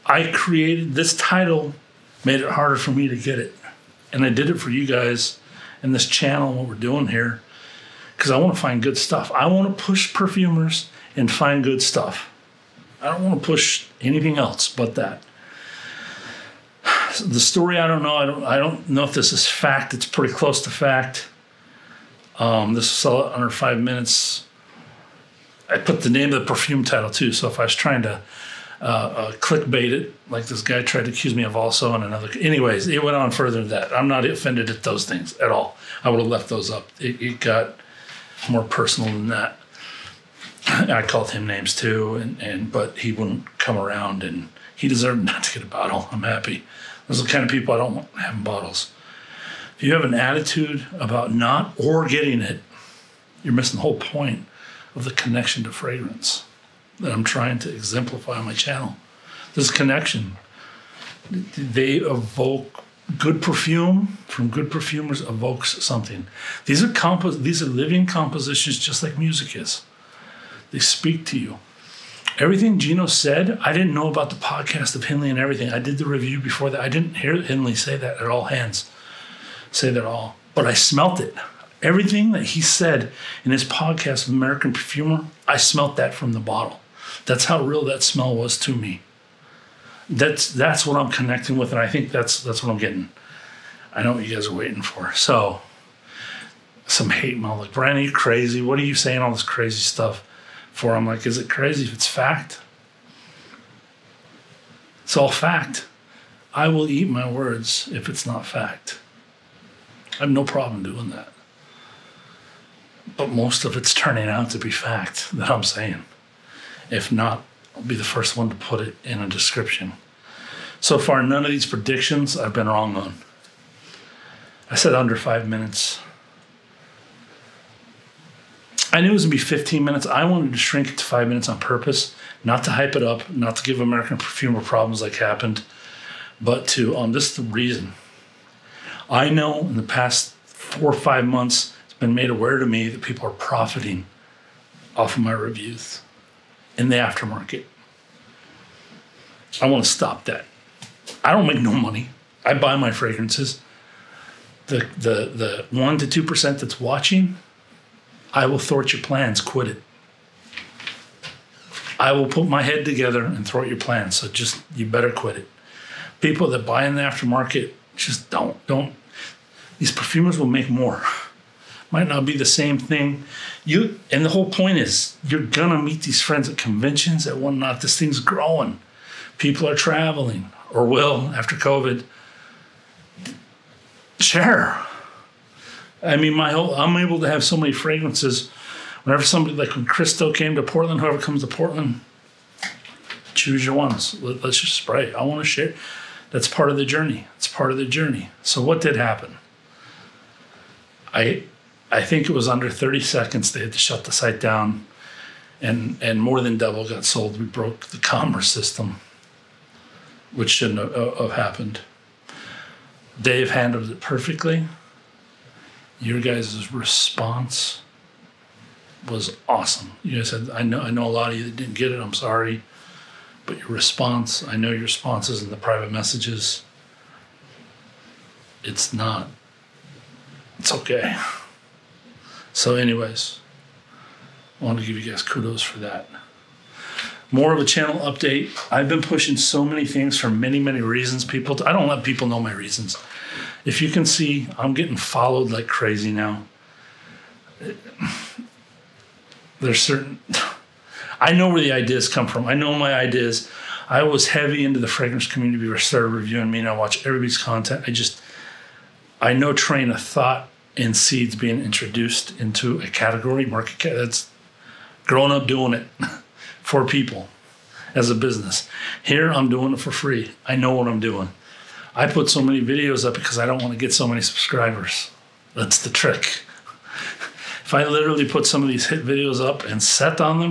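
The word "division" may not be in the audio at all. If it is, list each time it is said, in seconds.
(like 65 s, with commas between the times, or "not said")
not said.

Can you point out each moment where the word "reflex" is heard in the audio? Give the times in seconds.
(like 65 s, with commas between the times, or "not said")
not said.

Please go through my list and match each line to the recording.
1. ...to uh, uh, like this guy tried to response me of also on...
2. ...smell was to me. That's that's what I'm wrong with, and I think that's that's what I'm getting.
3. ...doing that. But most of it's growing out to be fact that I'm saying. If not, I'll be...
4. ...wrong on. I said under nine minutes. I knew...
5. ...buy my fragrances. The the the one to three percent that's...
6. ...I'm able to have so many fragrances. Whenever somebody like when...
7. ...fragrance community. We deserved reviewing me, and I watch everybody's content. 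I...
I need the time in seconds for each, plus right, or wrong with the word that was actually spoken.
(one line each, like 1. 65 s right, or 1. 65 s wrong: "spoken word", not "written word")
1. 28 s wrong: "accuse", not "response"
2. 88 s wrong: "connecting", not "wrong"
3. 110 s wrong: "turning", not "growing"
4. 122 s wrong: "five", not "nine"
5. 152 s wrong: "two", not "three"
6. 186 s right
7. 254 s wrong: "started", not "deserved".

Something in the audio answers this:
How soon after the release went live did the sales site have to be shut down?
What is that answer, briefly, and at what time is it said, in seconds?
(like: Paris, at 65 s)
under 30 seconds, at 202 s.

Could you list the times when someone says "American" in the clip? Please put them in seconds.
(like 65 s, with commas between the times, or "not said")
84 s, 133 s.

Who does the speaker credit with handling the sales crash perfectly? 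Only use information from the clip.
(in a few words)
Dave.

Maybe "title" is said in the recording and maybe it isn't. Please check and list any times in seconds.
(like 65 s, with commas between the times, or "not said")
1 s, 26 s.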